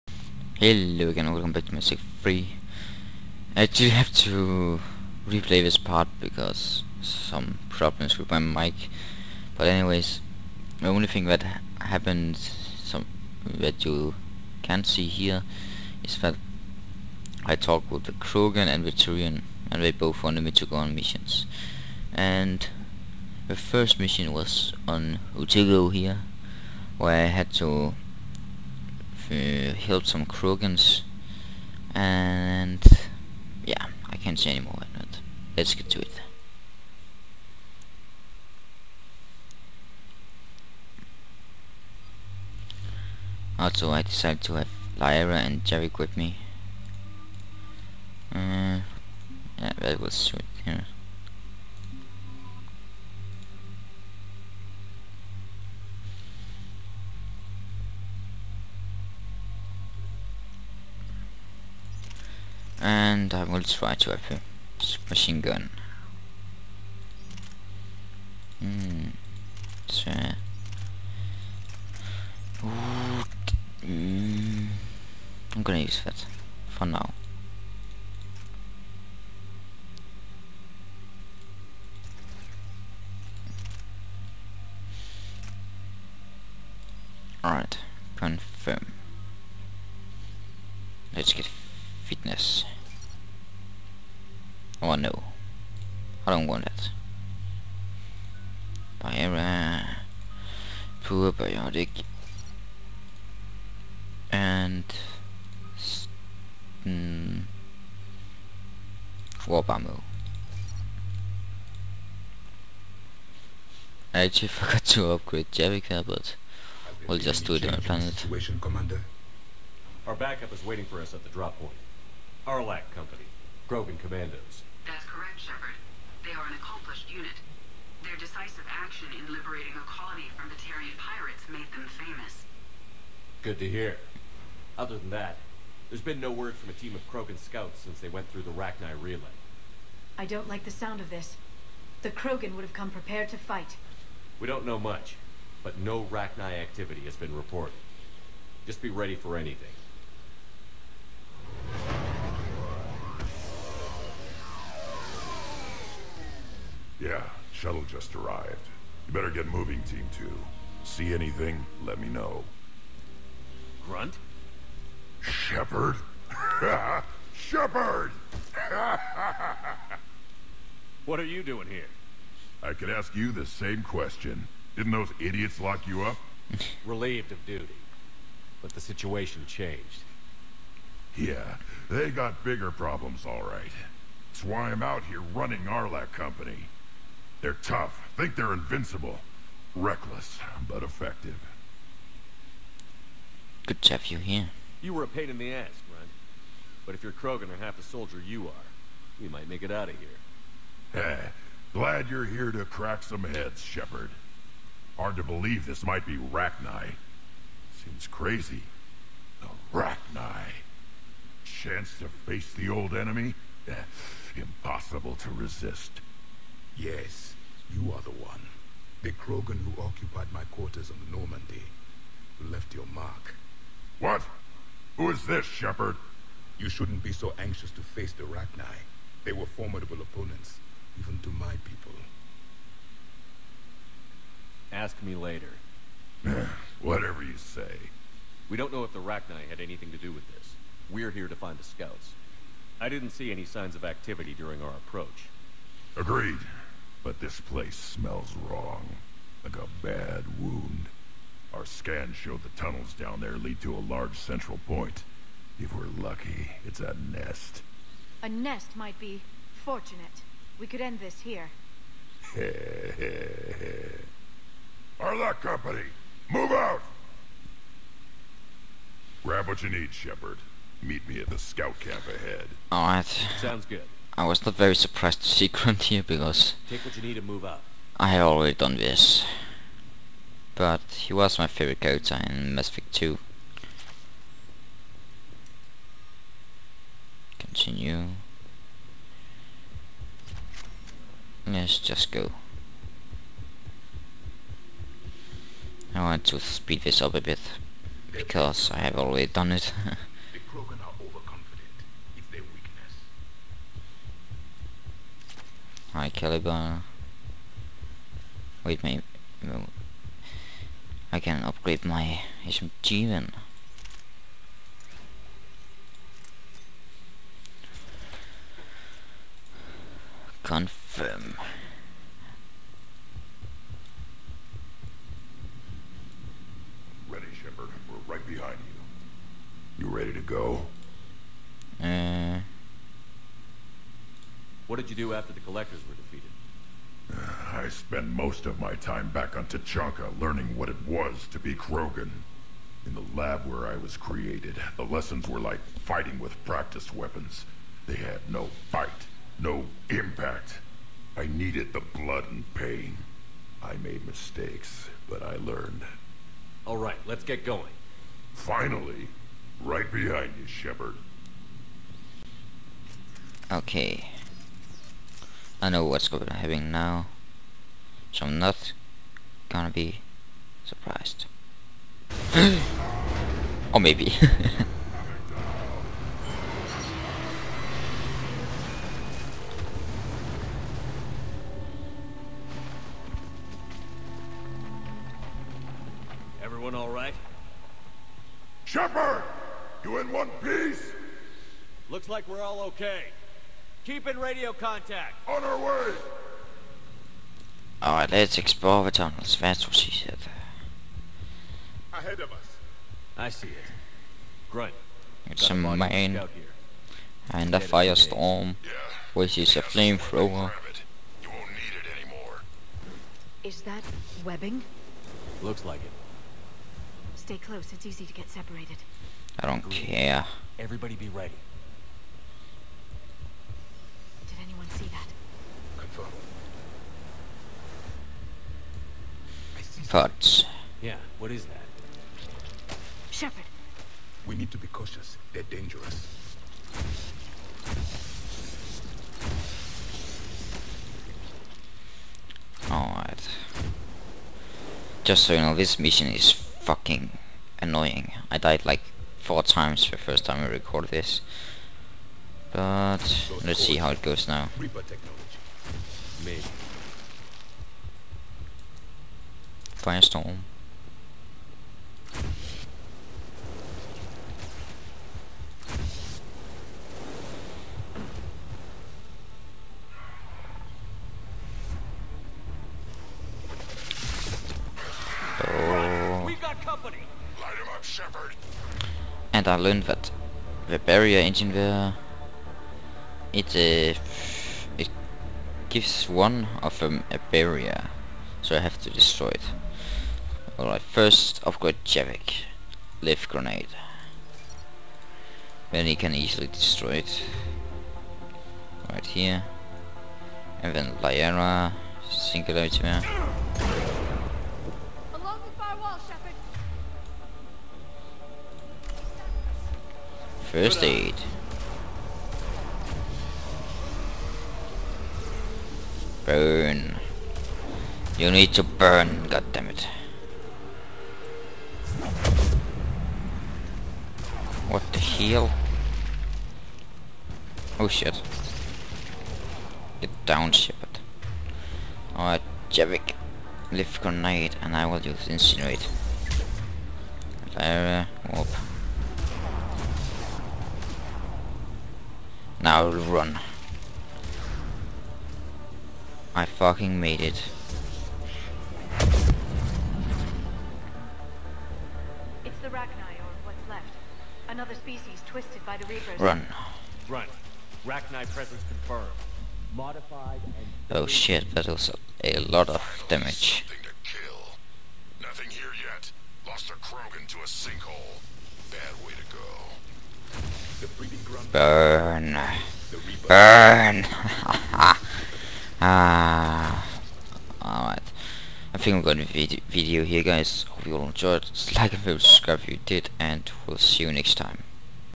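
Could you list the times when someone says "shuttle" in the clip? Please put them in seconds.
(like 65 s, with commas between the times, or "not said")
157 s.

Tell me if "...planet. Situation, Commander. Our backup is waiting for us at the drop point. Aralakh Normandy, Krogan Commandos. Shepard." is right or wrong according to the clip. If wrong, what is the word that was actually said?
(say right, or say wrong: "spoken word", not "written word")
wrong: "Company", not "Normandy".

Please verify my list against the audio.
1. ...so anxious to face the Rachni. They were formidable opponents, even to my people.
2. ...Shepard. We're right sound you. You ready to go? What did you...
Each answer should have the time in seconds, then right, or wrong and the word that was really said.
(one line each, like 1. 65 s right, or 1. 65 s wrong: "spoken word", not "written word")
1. 227 s right
2. 327 s wrong: "behind", not "sound".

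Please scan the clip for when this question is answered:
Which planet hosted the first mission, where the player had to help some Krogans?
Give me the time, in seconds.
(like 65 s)
25 s.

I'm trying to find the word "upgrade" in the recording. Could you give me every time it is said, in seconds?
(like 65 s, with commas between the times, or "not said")
115 s, 311 s, 491 s.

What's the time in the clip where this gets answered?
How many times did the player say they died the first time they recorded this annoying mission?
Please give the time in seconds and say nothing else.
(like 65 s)
449 s.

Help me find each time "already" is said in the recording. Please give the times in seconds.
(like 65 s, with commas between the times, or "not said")
278 s, 298 s.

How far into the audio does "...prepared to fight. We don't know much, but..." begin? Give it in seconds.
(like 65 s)
142 s.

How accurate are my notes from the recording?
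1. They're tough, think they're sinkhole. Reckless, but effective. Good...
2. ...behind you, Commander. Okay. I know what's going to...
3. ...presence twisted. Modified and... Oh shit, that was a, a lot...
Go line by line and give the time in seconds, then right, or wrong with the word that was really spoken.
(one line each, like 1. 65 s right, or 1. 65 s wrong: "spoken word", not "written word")
1. 187 s wrong: "invincible", not "sinkhole"
2. 359 s wrong: "Shepard", not "Commander"
3. 558 s wrong: "confirmed", not "twisted".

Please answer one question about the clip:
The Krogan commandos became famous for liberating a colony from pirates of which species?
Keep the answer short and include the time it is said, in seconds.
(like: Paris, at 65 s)
Terrian, at 130 s.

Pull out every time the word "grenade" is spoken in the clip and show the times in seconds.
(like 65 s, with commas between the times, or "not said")
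493 s, 534 s.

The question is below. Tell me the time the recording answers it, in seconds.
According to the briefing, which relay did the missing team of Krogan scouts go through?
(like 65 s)
138 s.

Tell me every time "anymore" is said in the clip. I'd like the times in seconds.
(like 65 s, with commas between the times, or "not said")
34 s, 412 s.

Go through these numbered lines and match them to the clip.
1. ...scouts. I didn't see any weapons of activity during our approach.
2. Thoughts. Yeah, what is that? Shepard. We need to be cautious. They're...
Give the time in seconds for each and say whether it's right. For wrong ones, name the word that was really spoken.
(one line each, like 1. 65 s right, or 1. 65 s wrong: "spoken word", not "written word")
1. 241 s wrong: "signs", not "weapons"
2. 429 s right.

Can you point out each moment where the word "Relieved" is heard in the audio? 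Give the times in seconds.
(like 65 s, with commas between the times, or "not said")
176 s.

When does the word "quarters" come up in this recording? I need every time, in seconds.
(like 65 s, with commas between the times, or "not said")
220 s.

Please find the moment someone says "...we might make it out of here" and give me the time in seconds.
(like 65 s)
199 s.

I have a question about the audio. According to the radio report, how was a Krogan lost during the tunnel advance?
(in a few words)
to a sinkhole.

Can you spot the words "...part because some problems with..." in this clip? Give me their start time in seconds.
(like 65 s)
5 s.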